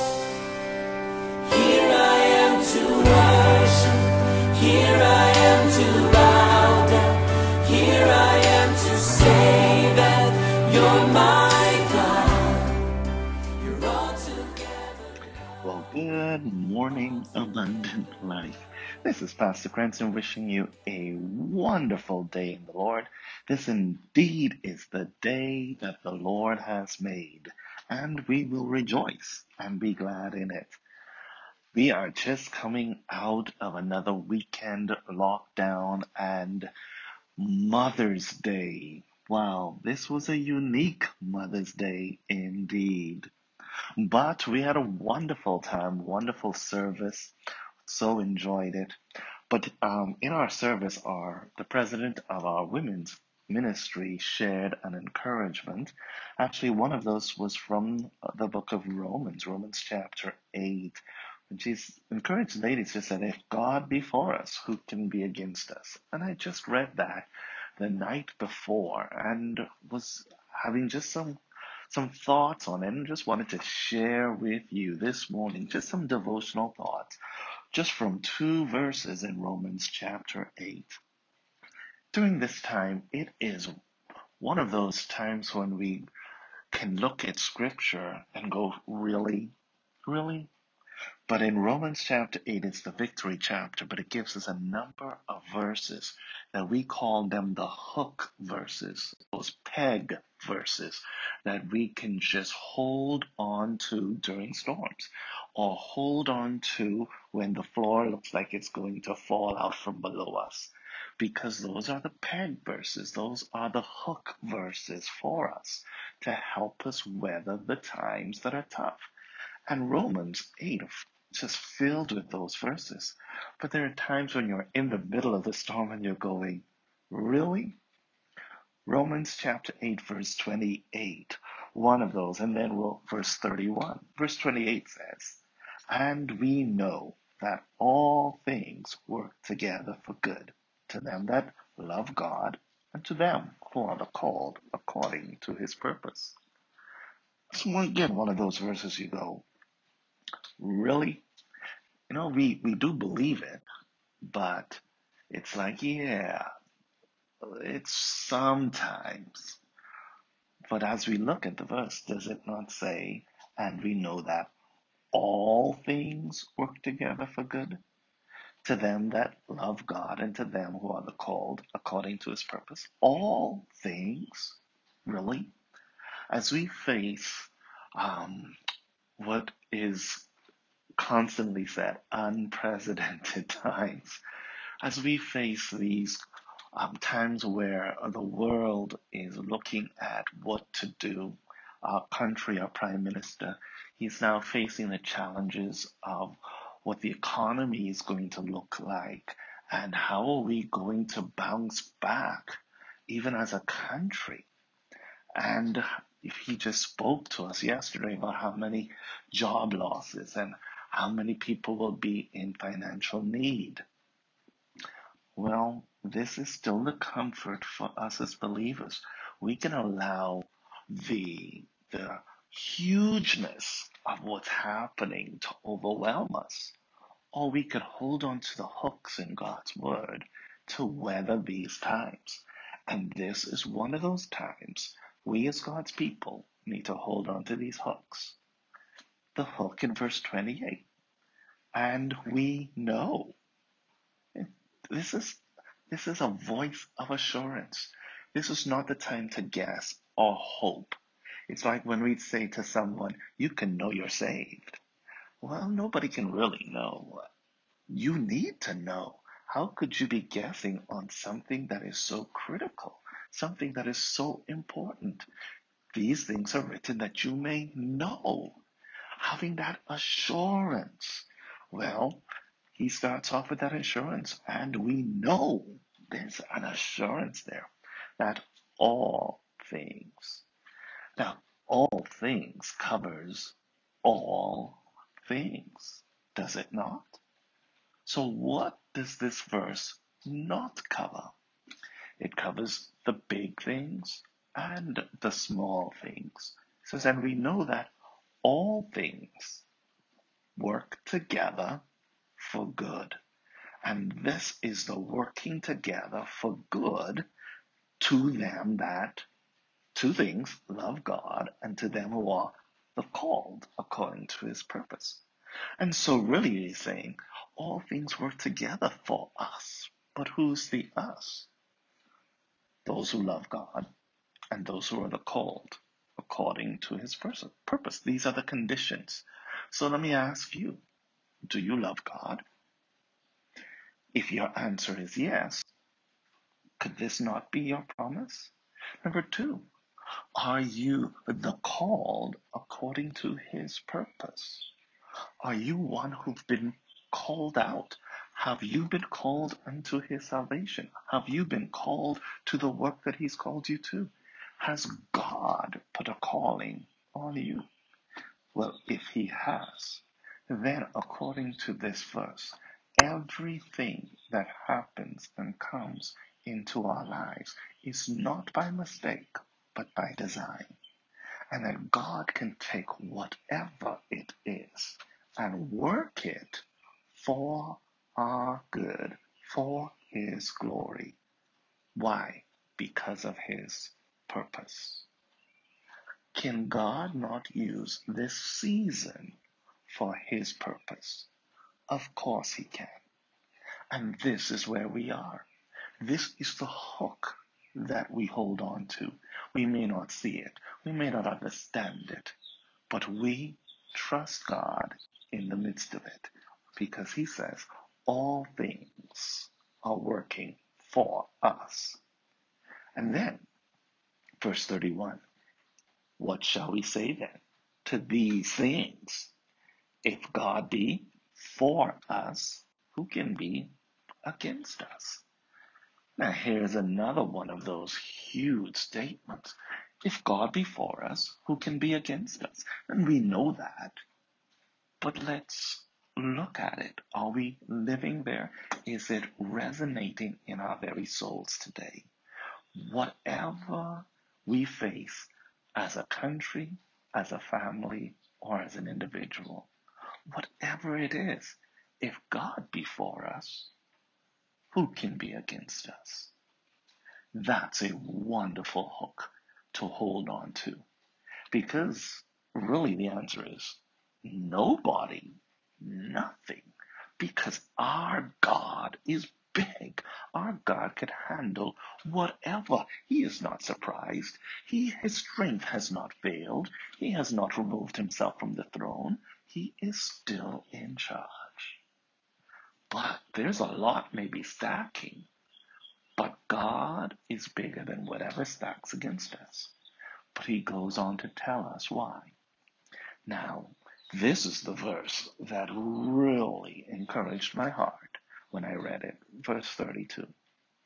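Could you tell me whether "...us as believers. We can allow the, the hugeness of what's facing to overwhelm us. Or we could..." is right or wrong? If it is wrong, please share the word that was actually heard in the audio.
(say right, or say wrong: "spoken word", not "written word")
wrong: "happening", not "facing".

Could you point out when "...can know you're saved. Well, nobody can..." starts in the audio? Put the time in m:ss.
4:13.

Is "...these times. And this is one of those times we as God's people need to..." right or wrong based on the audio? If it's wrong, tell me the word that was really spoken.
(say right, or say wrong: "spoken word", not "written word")
right.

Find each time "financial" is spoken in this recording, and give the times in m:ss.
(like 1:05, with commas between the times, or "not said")
3:32.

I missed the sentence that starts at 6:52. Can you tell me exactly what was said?
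And then Verse 31 What shall we say then to these things?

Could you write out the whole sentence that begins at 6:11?
And that God can take whatever it is and work it for our good, for His glory.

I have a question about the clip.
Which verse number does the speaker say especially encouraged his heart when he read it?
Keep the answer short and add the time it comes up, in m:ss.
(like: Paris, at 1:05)
32, at 8:19.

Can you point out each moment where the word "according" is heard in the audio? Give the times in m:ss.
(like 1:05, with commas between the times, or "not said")
2:24, 2:51, 5:13, 5:26, 5:42, 6:00.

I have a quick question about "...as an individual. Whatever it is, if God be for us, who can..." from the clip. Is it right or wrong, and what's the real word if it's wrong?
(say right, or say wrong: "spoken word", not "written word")
right.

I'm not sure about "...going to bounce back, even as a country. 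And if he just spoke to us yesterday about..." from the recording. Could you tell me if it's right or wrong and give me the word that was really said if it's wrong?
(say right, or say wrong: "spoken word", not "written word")
right.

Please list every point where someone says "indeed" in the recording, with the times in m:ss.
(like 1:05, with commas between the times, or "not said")
0:23, 0:42.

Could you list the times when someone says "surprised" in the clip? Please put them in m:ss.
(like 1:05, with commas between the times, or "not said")
7:53.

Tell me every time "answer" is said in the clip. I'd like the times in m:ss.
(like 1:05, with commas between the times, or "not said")
5:34, 7:43.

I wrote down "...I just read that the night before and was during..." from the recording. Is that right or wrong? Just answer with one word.
wrong.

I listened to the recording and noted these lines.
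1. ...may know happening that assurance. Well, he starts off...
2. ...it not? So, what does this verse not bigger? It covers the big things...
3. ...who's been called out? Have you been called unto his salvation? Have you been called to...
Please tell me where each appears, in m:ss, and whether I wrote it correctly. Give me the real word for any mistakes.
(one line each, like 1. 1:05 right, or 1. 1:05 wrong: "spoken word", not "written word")
1. 4:27 wrong: "having", not "happening"
2. 4:46 wrong: "cover", not "bigger"
3. 5:46 right.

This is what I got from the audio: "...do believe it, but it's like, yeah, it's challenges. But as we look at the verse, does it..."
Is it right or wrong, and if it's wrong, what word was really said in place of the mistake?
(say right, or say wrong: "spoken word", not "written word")
wrong: "sometimes", not "challenges".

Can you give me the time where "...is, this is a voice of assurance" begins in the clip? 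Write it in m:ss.
4:05.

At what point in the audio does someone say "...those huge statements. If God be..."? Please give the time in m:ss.
7:07.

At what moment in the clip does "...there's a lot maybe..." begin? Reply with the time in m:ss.
8:03.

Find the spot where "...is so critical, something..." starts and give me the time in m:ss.
4:21.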